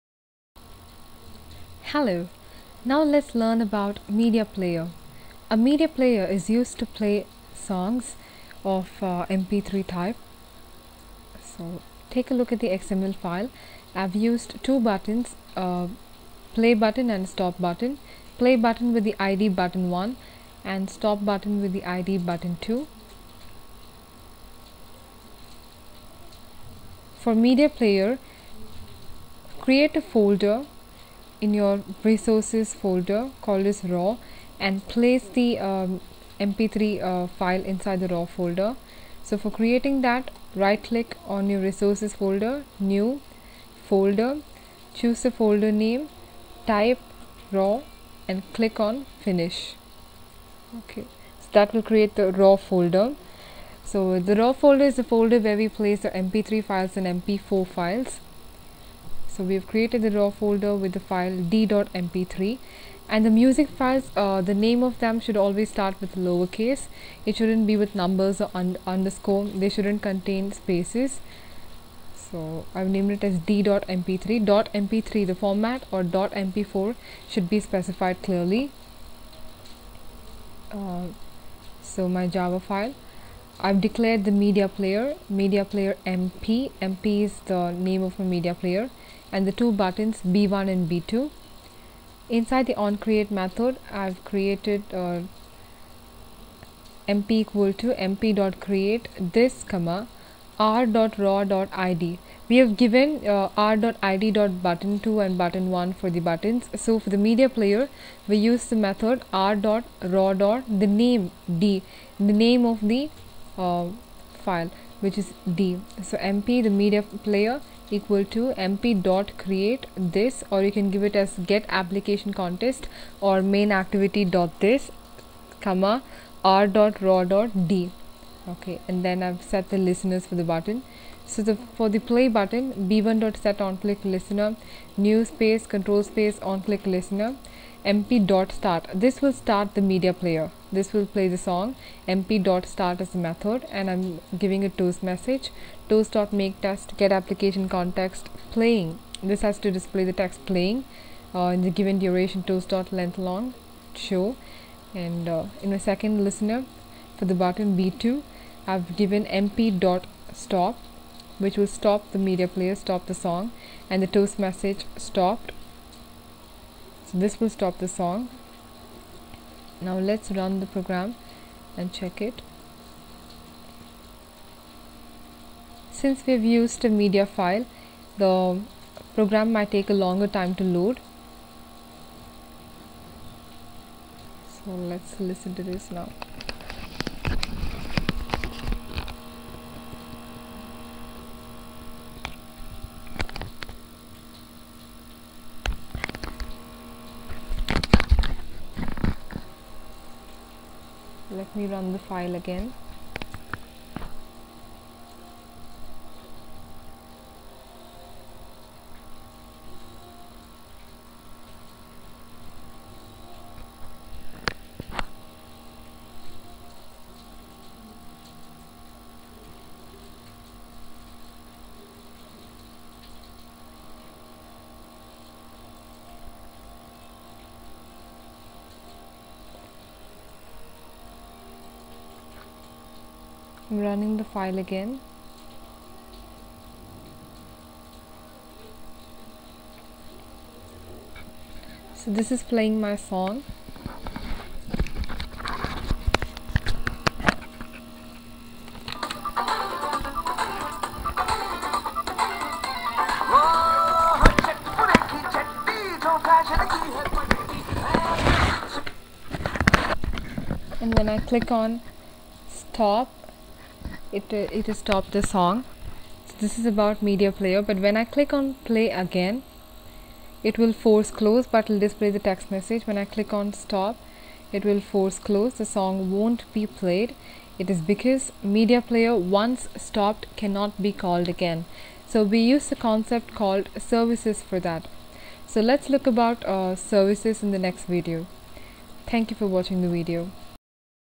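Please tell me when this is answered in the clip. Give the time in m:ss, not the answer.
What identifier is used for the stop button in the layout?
0:22.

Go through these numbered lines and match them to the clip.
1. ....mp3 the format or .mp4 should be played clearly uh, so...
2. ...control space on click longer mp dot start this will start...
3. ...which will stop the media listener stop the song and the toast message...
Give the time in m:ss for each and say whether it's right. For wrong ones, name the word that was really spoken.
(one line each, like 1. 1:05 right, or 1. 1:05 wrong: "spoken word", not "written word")
1. 1:14 wrong: "specified", not "played"
2. 2:15 wrong: "listener", not "longer"
3. 2:41 wrong: "player", not "listener".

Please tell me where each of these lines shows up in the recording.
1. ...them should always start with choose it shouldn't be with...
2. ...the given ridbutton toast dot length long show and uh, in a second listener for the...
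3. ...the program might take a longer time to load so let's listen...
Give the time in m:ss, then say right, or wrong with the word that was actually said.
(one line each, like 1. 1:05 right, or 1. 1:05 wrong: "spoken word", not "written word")
1. 1:04 wrong: "lowercase", not "choose"
2. 2:31 wrong: "duration", not "ridbutton"
3. 2:58 right.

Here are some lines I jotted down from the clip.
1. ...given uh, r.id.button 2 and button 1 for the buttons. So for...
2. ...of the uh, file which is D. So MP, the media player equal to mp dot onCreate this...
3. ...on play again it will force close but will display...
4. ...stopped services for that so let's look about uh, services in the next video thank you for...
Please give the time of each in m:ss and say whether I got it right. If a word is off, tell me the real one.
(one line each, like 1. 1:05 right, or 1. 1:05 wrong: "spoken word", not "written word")
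1. 1:42 right
2. 1:52 wrong: "create", not "onCreate"
3. 4:28 right
4. 4:43 wrong: "called", not "stopped".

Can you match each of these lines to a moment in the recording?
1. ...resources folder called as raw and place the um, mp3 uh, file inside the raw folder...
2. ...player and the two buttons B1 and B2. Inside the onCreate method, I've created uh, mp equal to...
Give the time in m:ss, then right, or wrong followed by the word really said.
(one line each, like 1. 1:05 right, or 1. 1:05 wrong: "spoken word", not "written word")
1. 0:32 right
2. 1:28 right.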